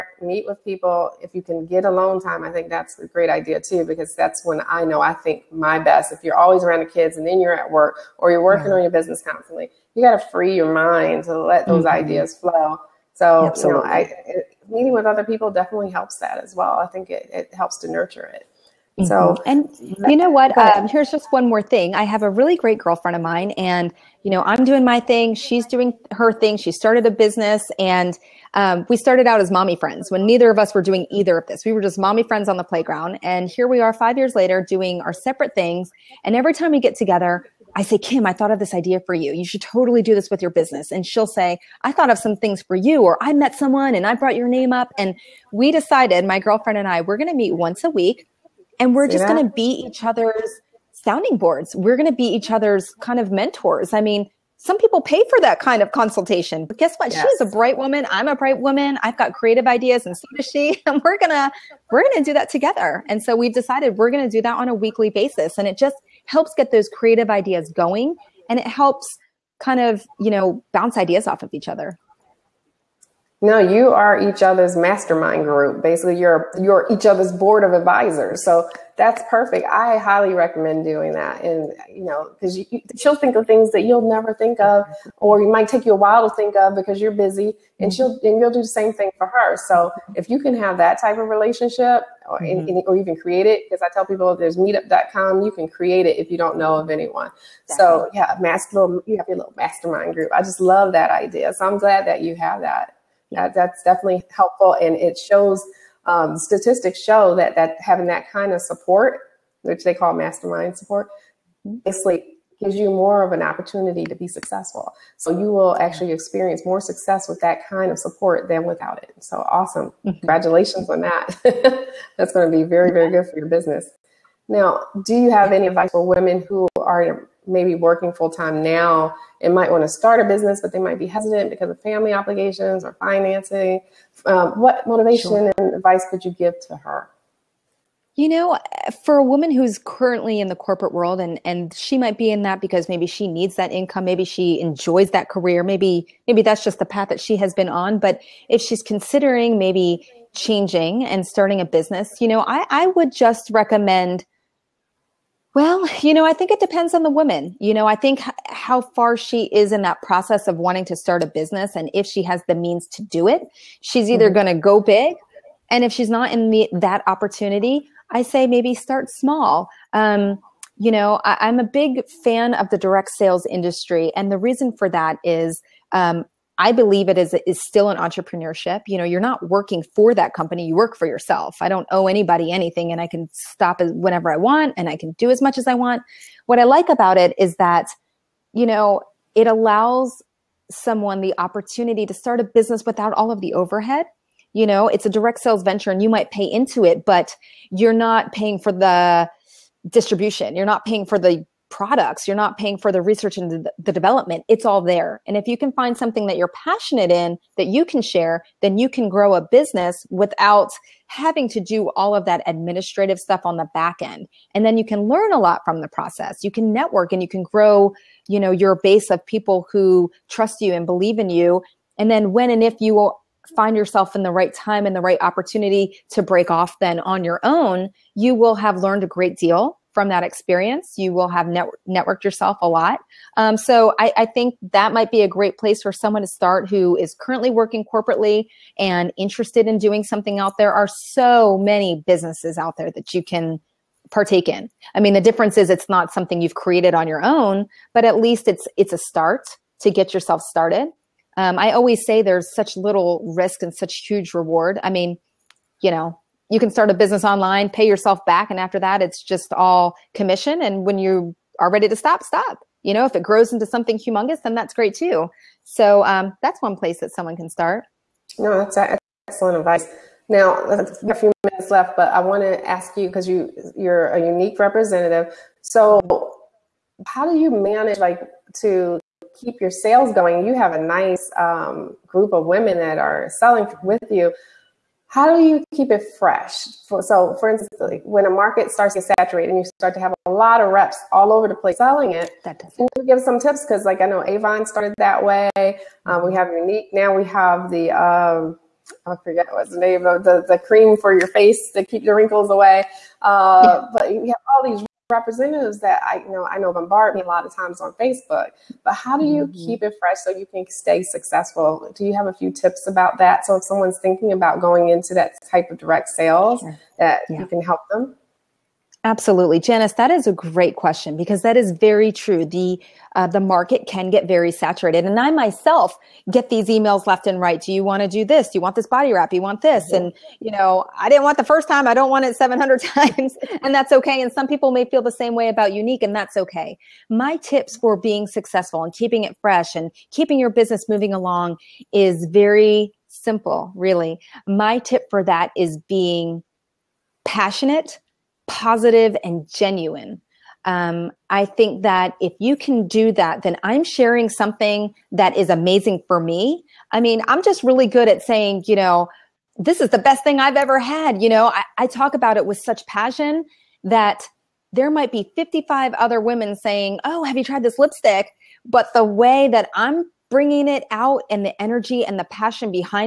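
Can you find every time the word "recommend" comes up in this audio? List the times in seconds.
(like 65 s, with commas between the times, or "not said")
80 s, 153 s.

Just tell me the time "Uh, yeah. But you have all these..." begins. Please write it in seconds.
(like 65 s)
303 s.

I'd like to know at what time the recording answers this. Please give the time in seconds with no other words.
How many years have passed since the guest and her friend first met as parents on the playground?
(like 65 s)
33 s.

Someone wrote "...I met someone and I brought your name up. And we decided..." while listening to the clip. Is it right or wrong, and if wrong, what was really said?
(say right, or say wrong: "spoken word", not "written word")
right.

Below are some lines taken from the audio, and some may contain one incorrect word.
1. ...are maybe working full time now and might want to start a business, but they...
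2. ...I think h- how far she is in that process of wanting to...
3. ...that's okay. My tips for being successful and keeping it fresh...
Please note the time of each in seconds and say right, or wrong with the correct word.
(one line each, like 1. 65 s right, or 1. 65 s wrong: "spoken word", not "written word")
1. 126 s right
2. 157 s right
3. 336 s right.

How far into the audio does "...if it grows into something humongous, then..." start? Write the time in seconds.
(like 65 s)
263 s.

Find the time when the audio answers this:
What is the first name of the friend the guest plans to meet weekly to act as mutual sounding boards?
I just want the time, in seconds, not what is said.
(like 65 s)
37 s.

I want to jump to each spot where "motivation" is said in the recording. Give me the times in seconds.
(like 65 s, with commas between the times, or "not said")
134 s.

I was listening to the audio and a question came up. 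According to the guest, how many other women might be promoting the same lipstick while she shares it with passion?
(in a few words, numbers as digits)
55.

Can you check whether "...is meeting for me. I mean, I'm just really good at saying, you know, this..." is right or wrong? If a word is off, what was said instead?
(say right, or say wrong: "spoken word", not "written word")
wrong: "amazing", not "meeting".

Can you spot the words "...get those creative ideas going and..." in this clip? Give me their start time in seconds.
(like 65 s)
66 s.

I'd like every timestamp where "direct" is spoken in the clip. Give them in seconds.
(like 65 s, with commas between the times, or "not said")
172 s, 195 s, 315 s.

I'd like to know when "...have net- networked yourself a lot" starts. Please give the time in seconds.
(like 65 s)
231 s.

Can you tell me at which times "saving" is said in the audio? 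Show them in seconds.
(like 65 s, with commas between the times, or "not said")
not said.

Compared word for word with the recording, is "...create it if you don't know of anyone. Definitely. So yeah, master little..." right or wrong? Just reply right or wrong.
right.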